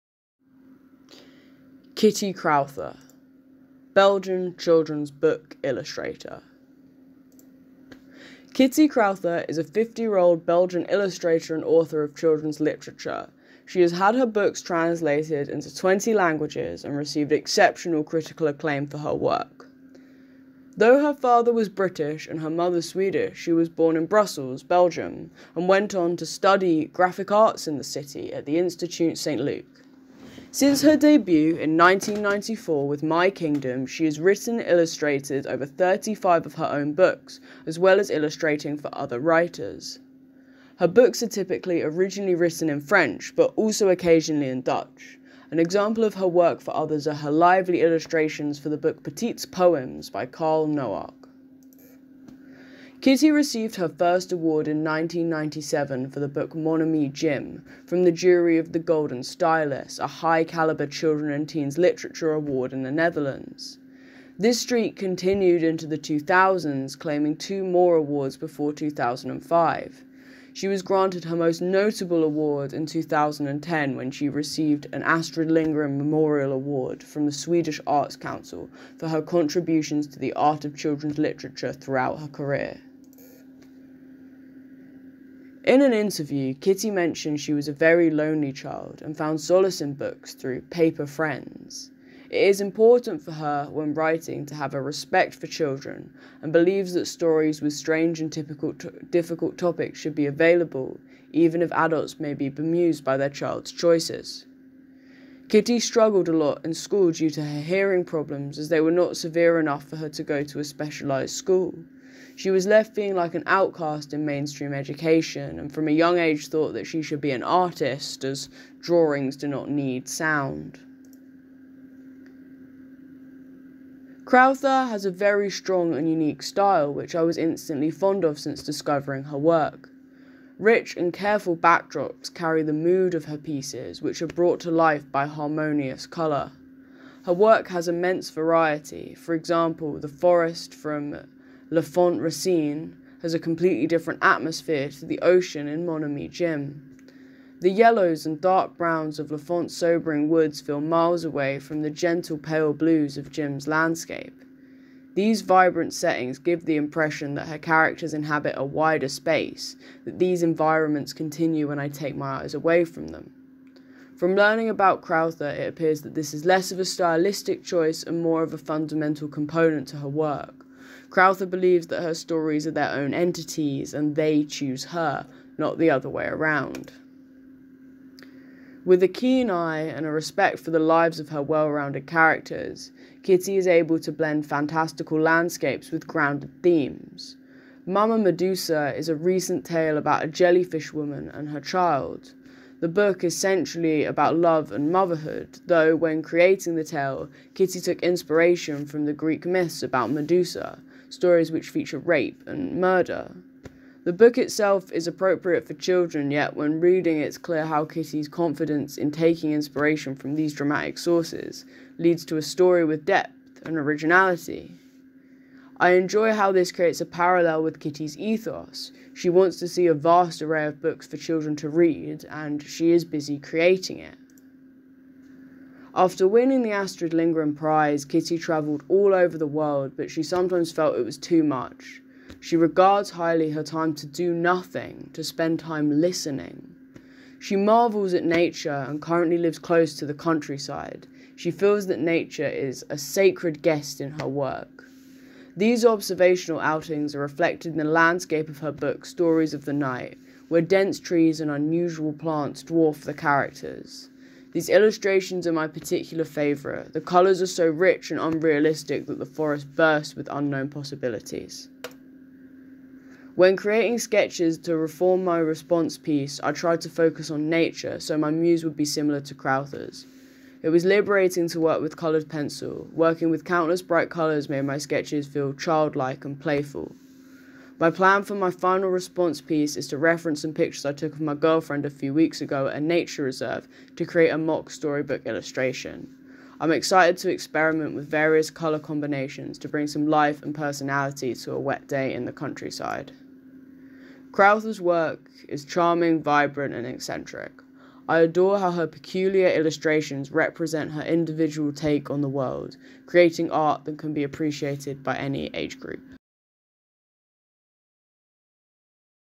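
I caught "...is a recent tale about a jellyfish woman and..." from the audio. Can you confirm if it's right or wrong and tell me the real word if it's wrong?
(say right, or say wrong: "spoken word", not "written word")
right.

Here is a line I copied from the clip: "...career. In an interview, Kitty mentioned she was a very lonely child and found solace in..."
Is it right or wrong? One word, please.
right.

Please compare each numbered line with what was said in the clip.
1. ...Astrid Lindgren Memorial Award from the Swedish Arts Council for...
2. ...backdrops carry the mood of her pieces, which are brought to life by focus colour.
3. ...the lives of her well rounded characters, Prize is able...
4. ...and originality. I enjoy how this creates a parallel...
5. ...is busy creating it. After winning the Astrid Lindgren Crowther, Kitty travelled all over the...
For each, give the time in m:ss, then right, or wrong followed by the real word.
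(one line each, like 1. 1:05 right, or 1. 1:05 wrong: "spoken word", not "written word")
1. 1:15 right
2. 2:11 wrong: "harmonious", not "focus"
3. 3:00 wrong: "Kitty", not "Prize"
4. 3:33 right
5. 3:42 wrong: "Prize", not "Crowther".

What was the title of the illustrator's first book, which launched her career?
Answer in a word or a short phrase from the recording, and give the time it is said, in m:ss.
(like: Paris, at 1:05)
My Kingdom, at 0:33.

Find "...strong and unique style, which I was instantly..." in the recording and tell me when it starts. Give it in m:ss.
2:05.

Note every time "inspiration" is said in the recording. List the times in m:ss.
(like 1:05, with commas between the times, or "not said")
3:18, 3:29.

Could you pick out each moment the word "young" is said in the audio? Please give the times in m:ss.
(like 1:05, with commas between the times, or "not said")
1:55.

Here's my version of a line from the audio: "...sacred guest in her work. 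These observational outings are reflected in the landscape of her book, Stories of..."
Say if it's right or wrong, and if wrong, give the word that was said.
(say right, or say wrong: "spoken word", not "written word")
right.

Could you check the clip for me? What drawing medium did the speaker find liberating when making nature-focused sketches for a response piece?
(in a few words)
coloured pencil.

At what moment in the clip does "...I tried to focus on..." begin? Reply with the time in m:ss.
4:26.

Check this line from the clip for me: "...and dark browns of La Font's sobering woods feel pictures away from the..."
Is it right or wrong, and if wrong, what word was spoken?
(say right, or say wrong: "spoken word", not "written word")
wrong: "miles", not "pictures".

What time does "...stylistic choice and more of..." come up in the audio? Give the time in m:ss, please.
2:46.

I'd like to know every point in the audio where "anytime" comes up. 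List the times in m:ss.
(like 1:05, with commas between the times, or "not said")
not said.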